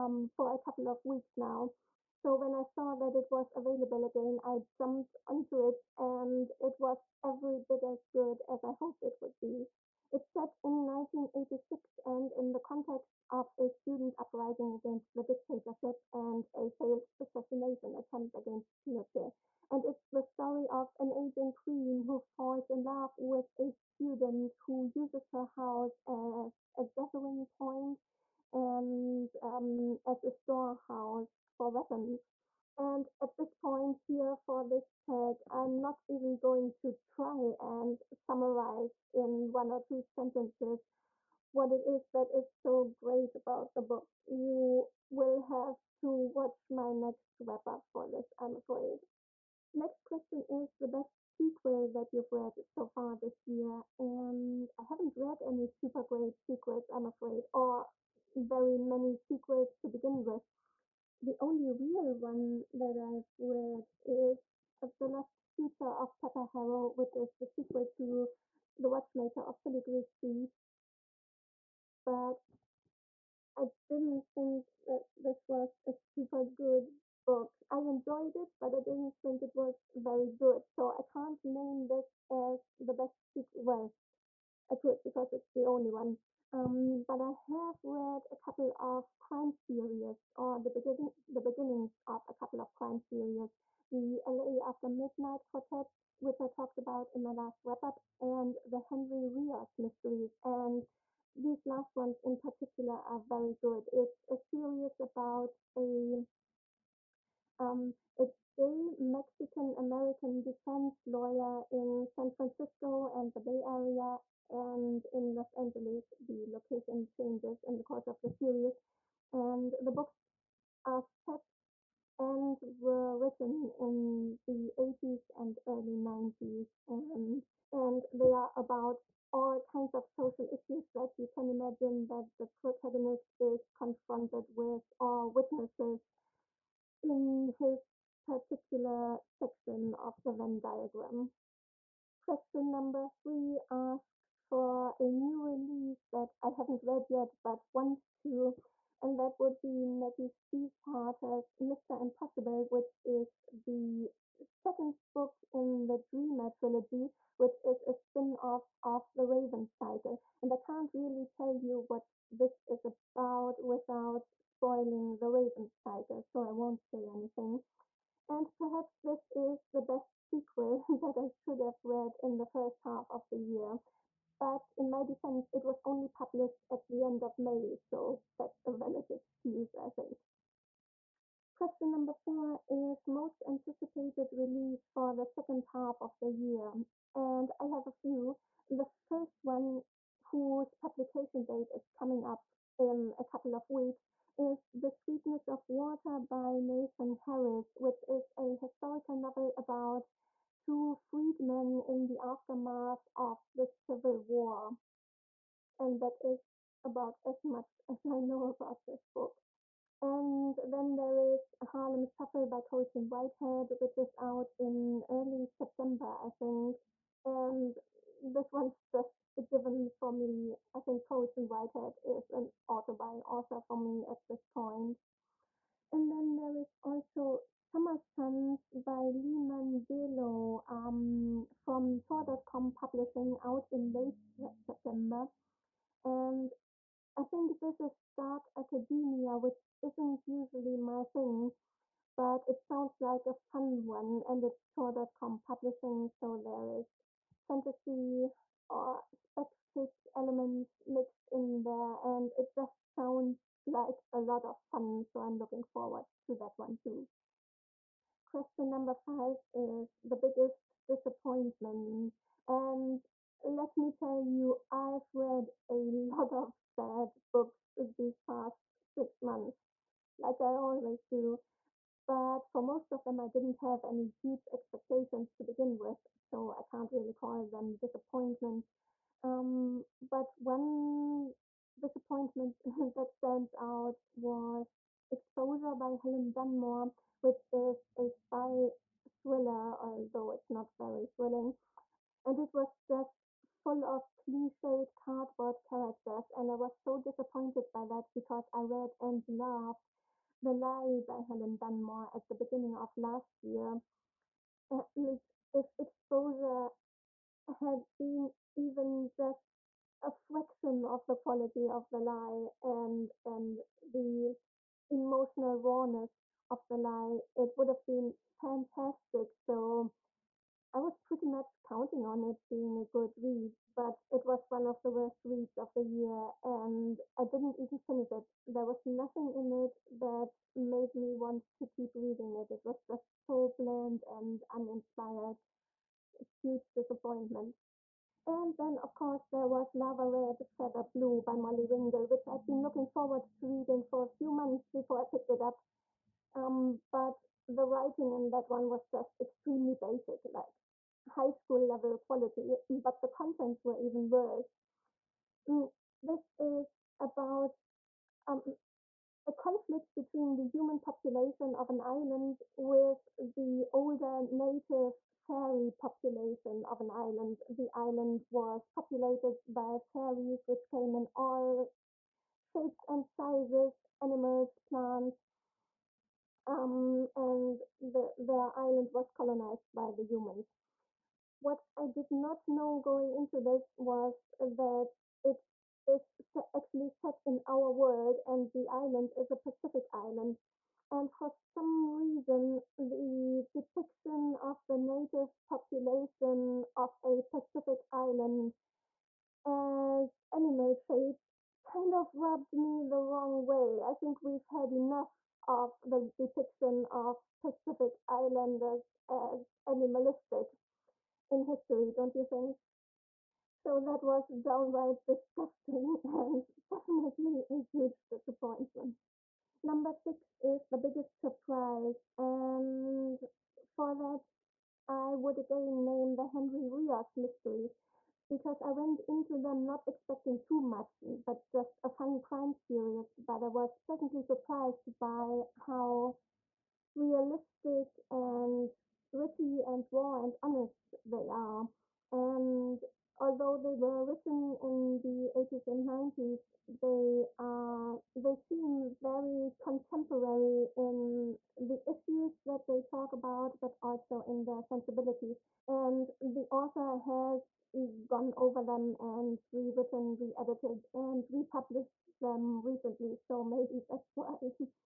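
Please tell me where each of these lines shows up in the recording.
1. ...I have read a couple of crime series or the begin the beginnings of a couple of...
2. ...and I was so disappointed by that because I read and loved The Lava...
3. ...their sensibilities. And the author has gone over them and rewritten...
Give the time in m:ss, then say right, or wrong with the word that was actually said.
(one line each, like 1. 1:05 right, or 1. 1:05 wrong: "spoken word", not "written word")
1. 1:27 right
2. 4:56 wrong: "Lie", not "Lava"
3. 7:34 right.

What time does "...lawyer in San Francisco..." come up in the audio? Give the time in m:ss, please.
1:51.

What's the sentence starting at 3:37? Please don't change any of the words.
And this one's just a given for me.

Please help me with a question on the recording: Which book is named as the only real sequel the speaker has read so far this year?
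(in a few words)
The Lost Future of Pepper Harrow.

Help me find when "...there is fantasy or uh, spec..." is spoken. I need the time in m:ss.
4:06.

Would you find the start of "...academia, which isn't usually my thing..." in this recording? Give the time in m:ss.
3:58.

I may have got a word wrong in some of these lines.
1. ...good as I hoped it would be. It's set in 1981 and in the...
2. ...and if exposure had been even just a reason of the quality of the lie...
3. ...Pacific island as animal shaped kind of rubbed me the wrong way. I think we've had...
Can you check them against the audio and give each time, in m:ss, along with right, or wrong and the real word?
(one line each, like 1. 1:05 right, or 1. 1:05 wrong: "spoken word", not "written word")
1. 0:08 wrong: "1986", not "1981"
2. 5:04 wrong: "fraction", not "reason"
3. 6:37 right.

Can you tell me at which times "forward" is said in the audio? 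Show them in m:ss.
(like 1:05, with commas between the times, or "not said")
4:15, 5:42.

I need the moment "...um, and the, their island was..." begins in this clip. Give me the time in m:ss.
6:16.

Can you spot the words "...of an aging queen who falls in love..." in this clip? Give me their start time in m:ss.
0:20.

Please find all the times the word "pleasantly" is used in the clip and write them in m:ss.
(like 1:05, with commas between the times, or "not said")
7:13.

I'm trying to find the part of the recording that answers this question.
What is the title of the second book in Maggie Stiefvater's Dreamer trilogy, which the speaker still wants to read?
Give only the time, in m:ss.
2:31.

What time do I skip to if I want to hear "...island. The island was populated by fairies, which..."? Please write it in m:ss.
6:06.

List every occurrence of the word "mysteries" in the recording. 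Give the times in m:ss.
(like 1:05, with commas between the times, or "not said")
1:39, 7:07.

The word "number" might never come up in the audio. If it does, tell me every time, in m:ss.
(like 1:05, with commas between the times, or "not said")
2:22, 3:01, 4:18, 6:59.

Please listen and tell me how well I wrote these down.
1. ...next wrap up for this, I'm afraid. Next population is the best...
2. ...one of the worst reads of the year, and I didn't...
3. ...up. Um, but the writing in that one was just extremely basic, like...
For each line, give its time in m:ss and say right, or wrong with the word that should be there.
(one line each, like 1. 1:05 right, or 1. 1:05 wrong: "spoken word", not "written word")
1. 0:46 wrong: "question", not "population"
2. 5:24 right
3. 5:45 right.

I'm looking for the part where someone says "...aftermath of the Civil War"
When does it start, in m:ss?
3:22.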